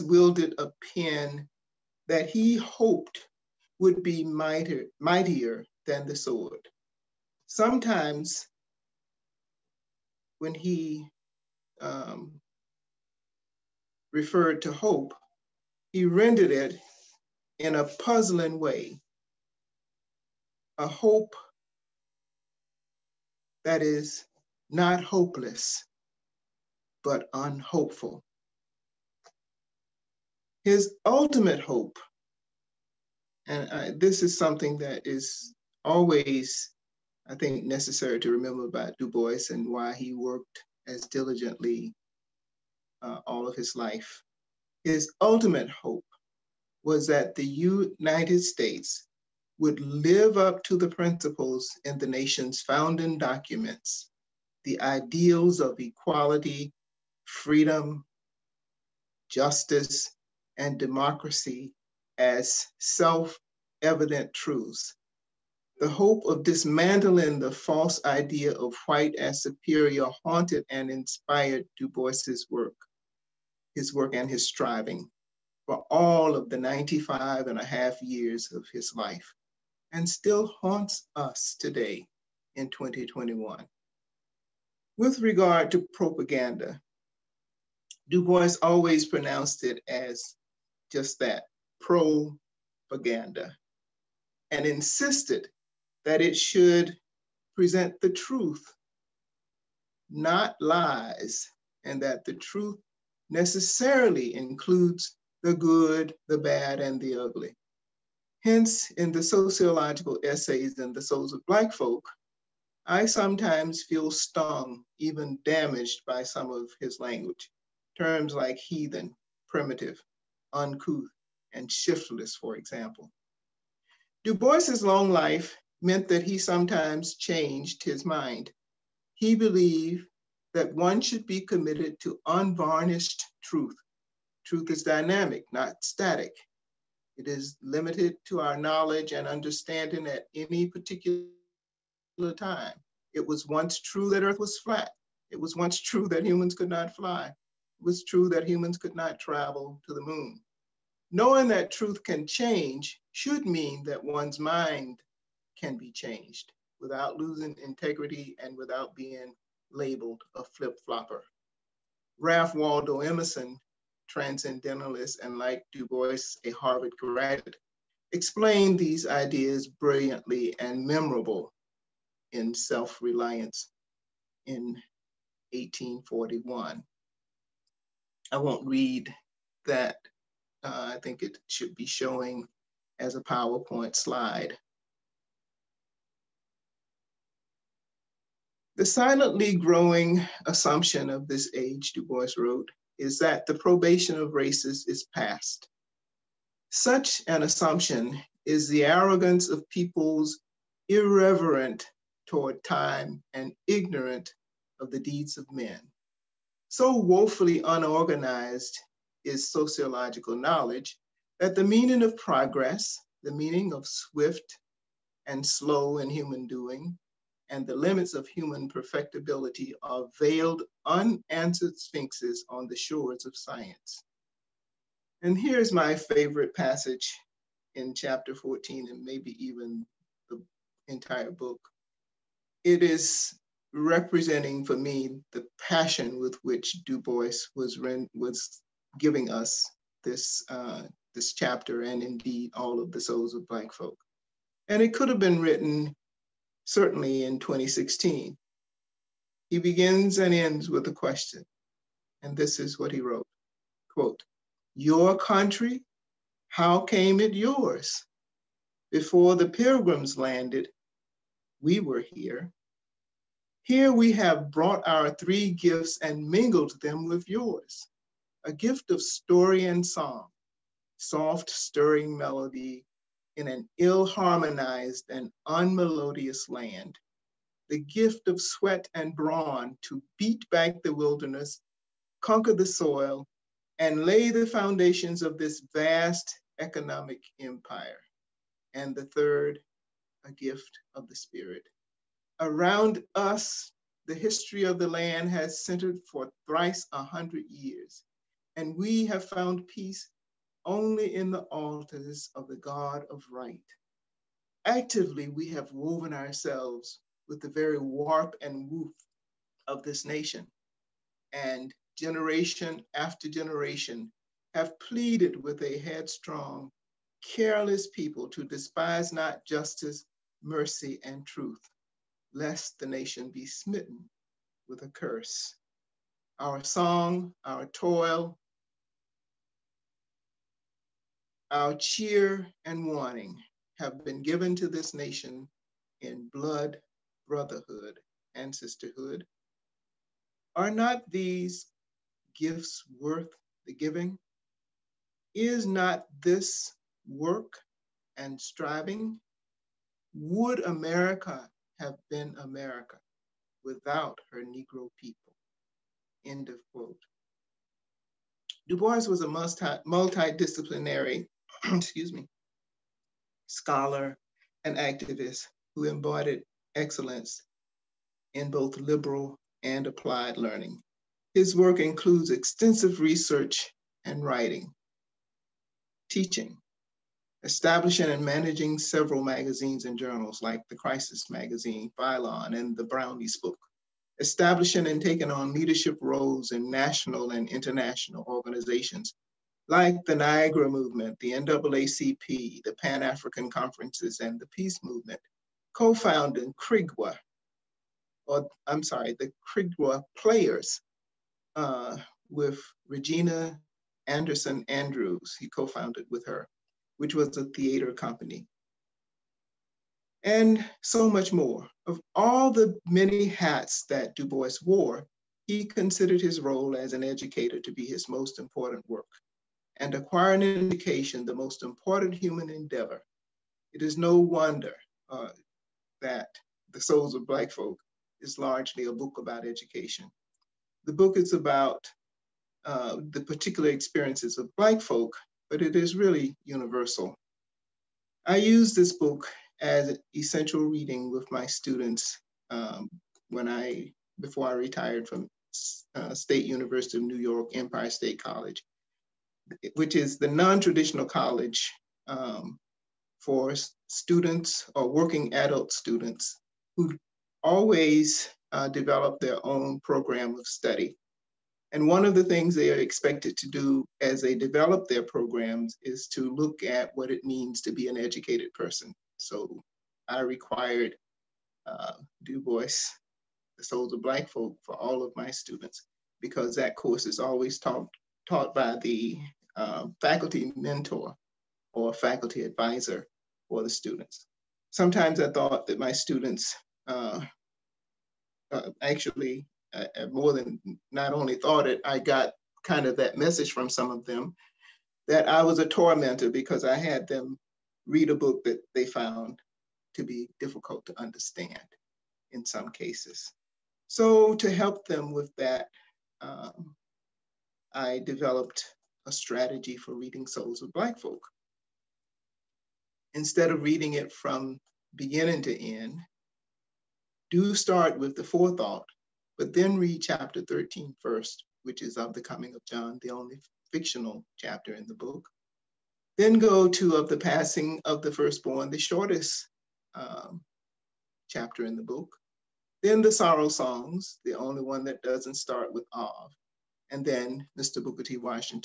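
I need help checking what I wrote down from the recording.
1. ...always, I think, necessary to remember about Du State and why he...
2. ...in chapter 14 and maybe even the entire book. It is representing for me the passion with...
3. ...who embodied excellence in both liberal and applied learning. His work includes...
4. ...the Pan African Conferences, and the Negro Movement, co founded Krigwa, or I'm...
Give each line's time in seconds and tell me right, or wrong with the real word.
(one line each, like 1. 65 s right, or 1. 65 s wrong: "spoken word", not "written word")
1. 35 s wrong: "Bois", not "State"
2. 227 s right
3. 365 s right
4. 392 s wrong: "Peace", not "Negro".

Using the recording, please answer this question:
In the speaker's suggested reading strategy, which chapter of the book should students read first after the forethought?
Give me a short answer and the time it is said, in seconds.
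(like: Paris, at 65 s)
Chapter 13, at 520 s.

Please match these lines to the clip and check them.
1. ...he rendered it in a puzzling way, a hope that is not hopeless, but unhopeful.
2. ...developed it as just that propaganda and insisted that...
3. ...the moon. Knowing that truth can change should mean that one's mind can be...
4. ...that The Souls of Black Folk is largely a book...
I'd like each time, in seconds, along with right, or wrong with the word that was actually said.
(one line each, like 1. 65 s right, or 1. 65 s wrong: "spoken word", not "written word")
1. 15 s right
2. 89 s wrong: "pronounced", not "developed"
3. 149 s right
4. 426 s right.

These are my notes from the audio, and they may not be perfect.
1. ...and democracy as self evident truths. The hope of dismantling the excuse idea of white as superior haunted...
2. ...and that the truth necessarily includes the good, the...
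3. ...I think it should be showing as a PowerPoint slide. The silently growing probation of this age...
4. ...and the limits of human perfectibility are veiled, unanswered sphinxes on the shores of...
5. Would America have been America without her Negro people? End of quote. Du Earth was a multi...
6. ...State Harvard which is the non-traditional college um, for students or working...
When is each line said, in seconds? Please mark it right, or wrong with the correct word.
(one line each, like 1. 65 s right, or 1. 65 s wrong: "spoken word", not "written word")
1. 60 s wrong: "false", not "excuse"
2. 101 s right
3. 180 s wrong: "assumption", not "probation"
4. 217 s right
5. 350 s wrong: "Bois", not "Earth"
6. 447 s wrong: "College", not "Harvard".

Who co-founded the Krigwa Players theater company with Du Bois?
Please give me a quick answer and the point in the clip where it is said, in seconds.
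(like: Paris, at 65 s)
Regina Anderson Andrews, at 402 s.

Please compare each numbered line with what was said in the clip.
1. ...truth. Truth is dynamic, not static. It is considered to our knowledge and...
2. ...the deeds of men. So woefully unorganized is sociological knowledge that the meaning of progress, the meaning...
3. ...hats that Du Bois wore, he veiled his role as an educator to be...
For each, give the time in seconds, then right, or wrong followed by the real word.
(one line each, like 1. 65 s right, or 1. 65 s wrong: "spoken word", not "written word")
1. 133 s wrong: "limited", not "considered"
2. 204 s right
3. 413 s wrong: "considered", not "veiled".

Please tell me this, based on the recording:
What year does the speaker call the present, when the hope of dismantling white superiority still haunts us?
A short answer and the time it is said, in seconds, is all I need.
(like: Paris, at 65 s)
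2021, at 82 s.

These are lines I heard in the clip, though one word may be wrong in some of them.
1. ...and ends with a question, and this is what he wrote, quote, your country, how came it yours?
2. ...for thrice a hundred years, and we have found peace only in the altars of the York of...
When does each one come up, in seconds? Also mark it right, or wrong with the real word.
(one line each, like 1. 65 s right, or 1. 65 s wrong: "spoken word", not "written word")
1. 250 s right
2. 296 s wrong: "God", not "York".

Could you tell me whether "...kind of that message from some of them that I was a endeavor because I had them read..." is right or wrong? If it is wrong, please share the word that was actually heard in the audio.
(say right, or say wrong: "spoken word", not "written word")
wrong: "tormentor", not "endeavor".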